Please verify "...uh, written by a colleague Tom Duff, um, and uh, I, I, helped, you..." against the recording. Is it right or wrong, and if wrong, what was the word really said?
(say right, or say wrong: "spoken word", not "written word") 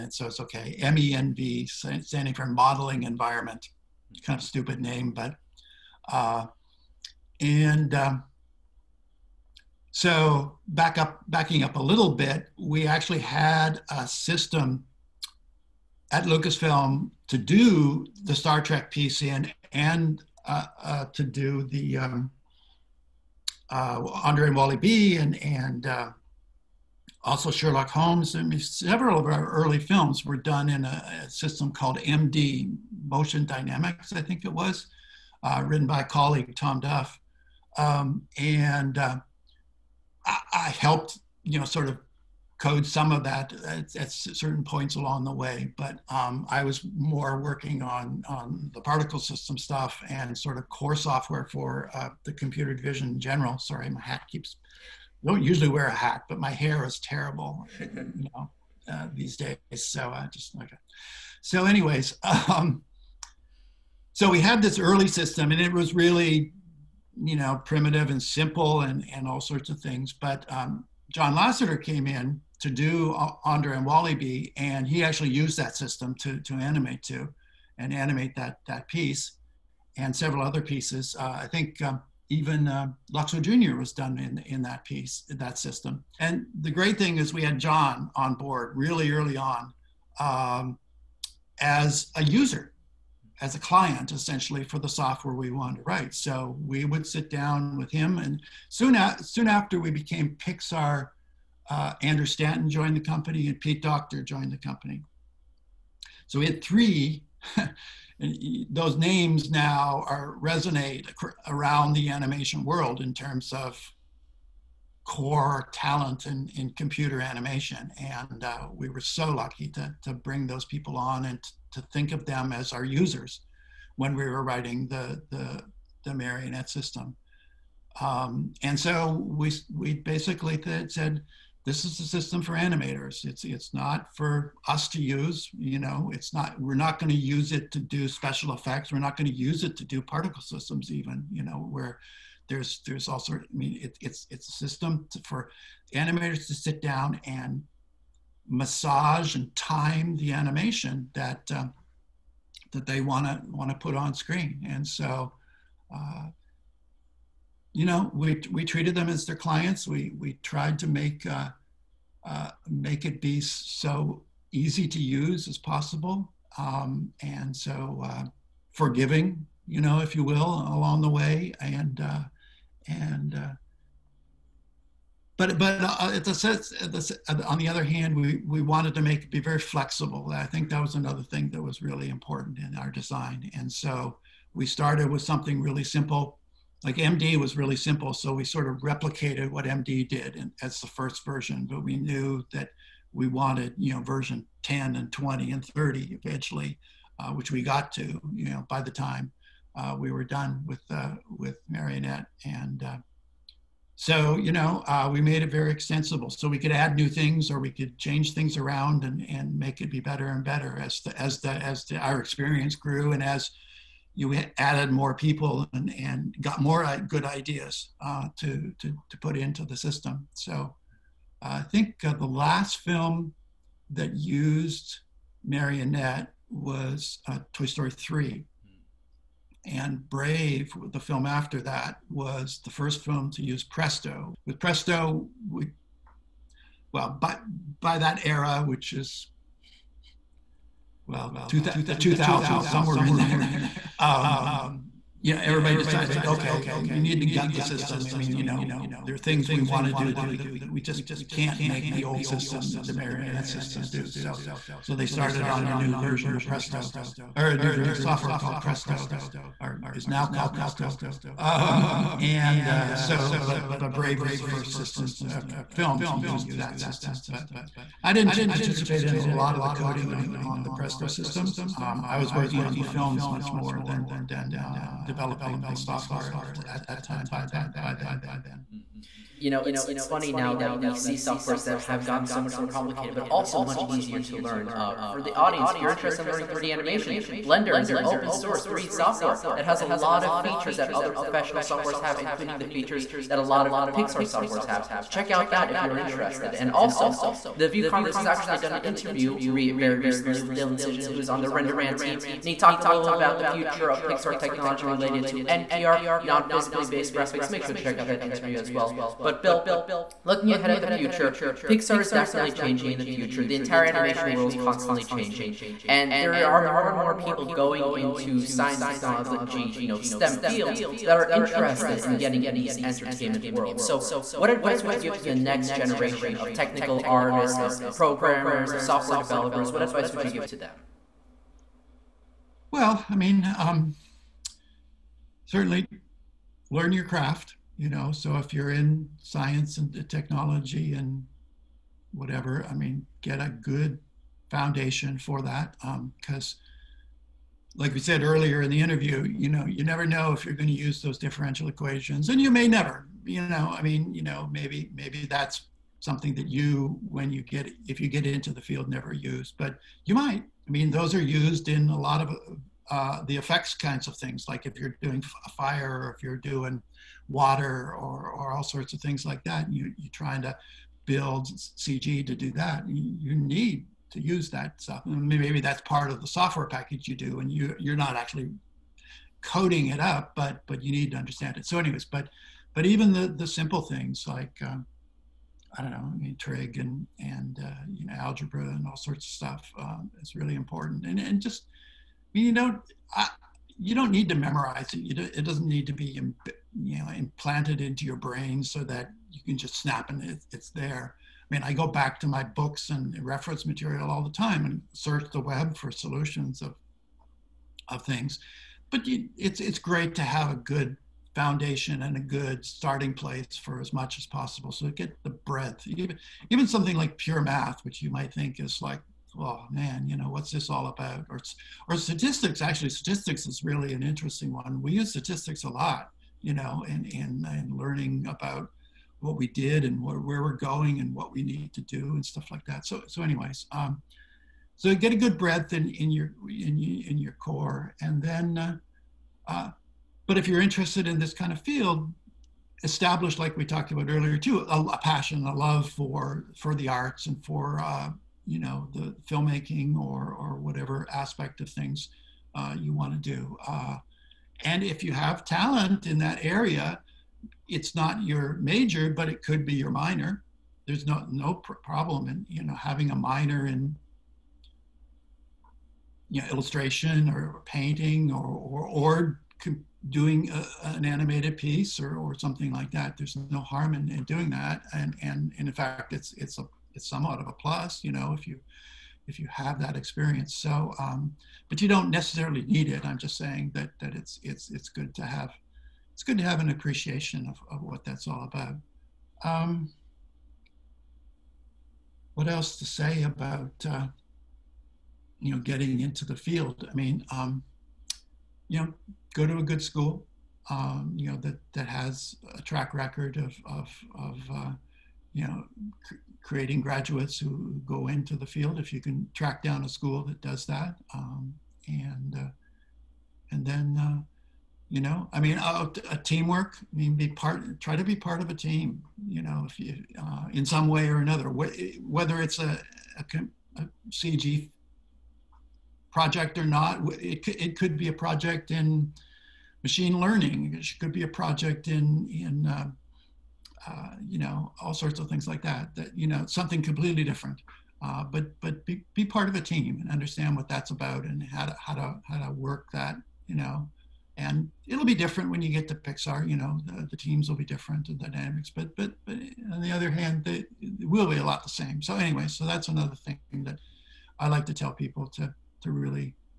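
right.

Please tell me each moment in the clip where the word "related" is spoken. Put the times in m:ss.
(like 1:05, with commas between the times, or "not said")
5:04.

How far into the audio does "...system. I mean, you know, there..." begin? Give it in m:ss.
4:07.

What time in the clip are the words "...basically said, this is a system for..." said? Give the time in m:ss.
2:09.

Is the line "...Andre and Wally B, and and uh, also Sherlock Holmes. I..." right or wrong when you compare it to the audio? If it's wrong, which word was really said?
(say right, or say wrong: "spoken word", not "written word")
right.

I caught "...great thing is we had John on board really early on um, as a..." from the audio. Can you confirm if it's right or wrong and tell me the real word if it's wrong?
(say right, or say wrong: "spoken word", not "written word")
right.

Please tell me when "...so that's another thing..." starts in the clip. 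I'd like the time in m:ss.
9:12.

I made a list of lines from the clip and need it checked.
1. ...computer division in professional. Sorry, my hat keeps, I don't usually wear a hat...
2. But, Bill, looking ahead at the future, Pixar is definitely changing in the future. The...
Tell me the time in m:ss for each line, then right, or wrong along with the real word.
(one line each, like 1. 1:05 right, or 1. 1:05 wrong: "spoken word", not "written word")
1. 0:52 wrong: "general", not "professional"
2. 5:09 right.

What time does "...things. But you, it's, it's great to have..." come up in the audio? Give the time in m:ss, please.
6:48.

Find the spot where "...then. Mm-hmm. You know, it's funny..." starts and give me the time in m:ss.
4:37.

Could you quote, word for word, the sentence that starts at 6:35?
Do, it doesn't need to be you know implanted into your brain so that you can just snap and it, it's there.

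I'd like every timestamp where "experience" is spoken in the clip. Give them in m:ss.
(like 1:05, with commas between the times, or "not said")
3:32, 7:59.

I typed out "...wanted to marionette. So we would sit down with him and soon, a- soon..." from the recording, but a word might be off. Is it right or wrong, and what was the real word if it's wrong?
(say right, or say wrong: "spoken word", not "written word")
wrong: "write", not "marionette".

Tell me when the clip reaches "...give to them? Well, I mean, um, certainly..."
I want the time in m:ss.
5:30.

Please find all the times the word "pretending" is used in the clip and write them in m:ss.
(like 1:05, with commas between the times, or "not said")
not said.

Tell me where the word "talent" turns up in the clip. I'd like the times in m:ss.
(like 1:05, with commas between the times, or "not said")
1:55, 7:35.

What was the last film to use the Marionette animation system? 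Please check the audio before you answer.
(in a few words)
Toy Story 3.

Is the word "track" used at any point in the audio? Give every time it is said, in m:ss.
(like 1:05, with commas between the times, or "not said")
8:22, 8:29.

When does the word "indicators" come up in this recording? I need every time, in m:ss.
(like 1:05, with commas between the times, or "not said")
not said.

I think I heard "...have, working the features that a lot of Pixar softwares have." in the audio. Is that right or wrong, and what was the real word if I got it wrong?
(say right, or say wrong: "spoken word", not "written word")
wrong: "including", not "working".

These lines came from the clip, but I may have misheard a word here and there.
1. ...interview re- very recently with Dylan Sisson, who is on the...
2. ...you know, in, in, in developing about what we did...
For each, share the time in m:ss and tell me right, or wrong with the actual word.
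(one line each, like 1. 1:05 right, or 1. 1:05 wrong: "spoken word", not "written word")
1. 4:58 right
2. 7:06 wrong: "learning", not "developing".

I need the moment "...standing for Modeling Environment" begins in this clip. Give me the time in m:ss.
0:01.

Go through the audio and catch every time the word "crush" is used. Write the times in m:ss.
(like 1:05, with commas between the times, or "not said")
not said.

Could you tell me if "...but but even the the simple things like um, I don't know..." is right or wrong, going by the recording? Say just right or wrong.
right.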